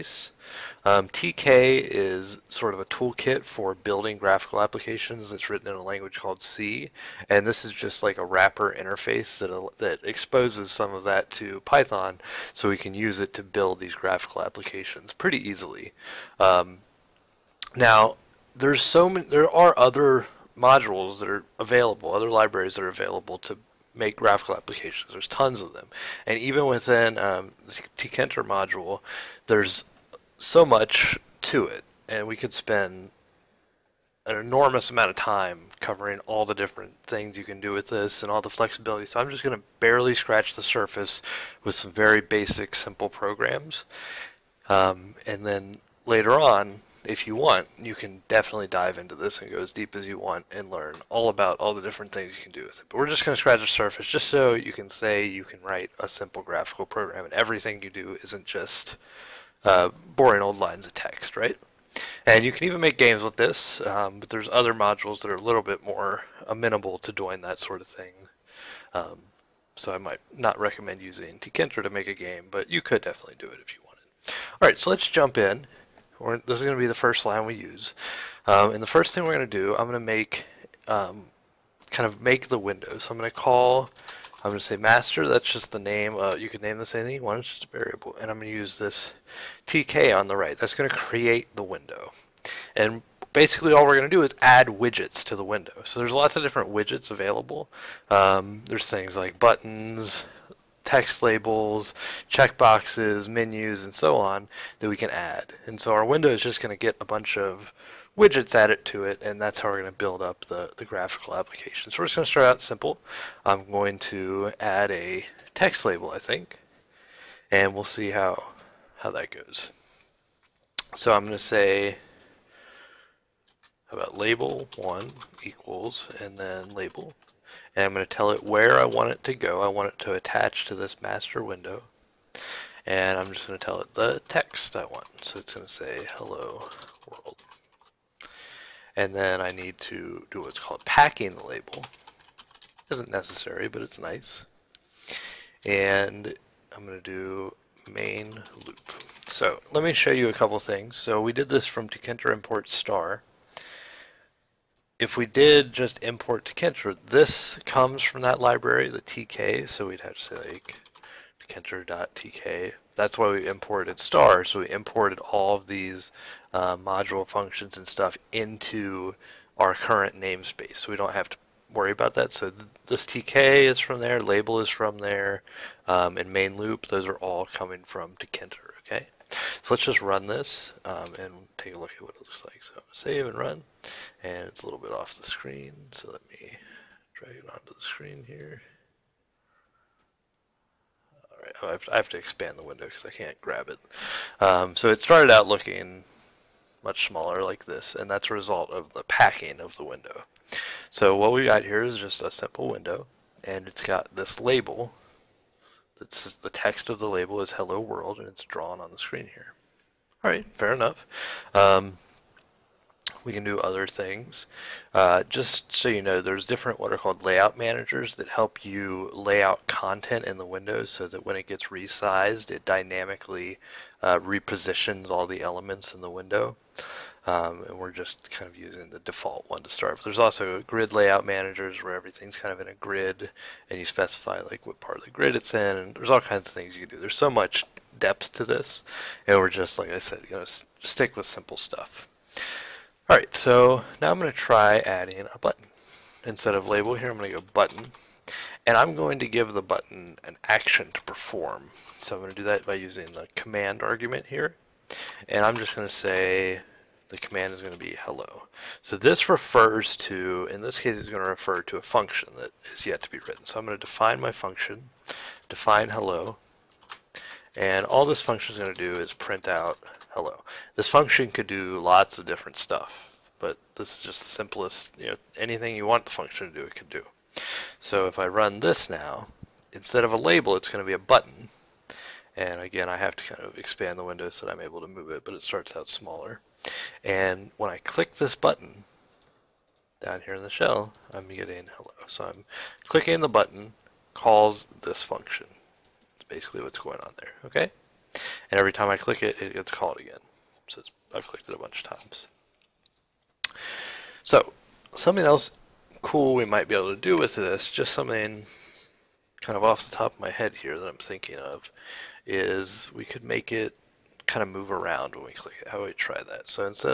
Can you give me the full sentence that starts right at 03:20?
So what we got here is just a simple window, and it's got this label.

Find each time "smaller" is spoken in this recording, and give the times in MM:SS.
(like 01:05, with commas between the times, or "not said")
03:17, 04:45.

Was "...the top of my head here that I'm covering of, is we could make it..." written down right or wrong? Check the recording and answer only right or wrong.
wrong.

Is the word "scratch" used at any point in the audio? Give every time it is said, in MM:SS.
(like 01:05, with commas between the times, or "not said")
00:40, 00:53.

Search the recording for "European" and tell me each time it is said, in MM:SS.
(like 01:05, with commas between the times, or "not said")
not said.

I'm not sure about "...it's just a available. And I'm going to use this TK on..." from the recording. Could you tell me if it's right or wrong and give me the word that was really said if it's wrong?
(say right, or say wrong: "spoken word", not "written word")
wrong: "variable", not "available".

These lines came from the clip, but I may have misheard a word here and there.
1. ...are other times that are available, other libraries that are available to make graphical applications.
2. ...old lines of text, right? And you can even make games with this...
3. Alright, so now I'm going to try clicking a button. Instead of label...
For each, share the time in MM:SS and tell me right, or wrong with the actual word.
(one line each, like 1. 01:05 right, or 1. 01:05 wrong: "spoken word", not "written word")
1. 00:19 wrong: "modules", not "times"
2. 01:00 right
3. 04:03 wrong: "adding", not "clicking".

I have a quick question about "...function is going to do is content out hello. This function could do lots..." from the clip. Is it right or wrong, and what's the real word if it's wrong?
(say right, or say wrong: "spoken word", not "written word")
wrong: "print", not "content".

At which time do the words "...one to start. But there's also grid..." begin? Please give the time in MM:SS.
03:49.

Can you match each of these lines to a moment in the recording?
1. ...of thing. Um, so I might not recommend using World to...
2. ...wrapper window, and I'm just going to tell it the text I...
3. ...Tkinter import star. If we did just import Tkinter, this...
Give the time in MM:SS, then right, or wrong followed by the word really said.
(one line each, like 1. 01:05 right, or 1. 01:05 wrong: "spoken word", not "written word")
1. 01:07 wrong: "Tkinter", not "World"
2. 02:11 wrong: "master", not "wrapper"
3. 02:31 right.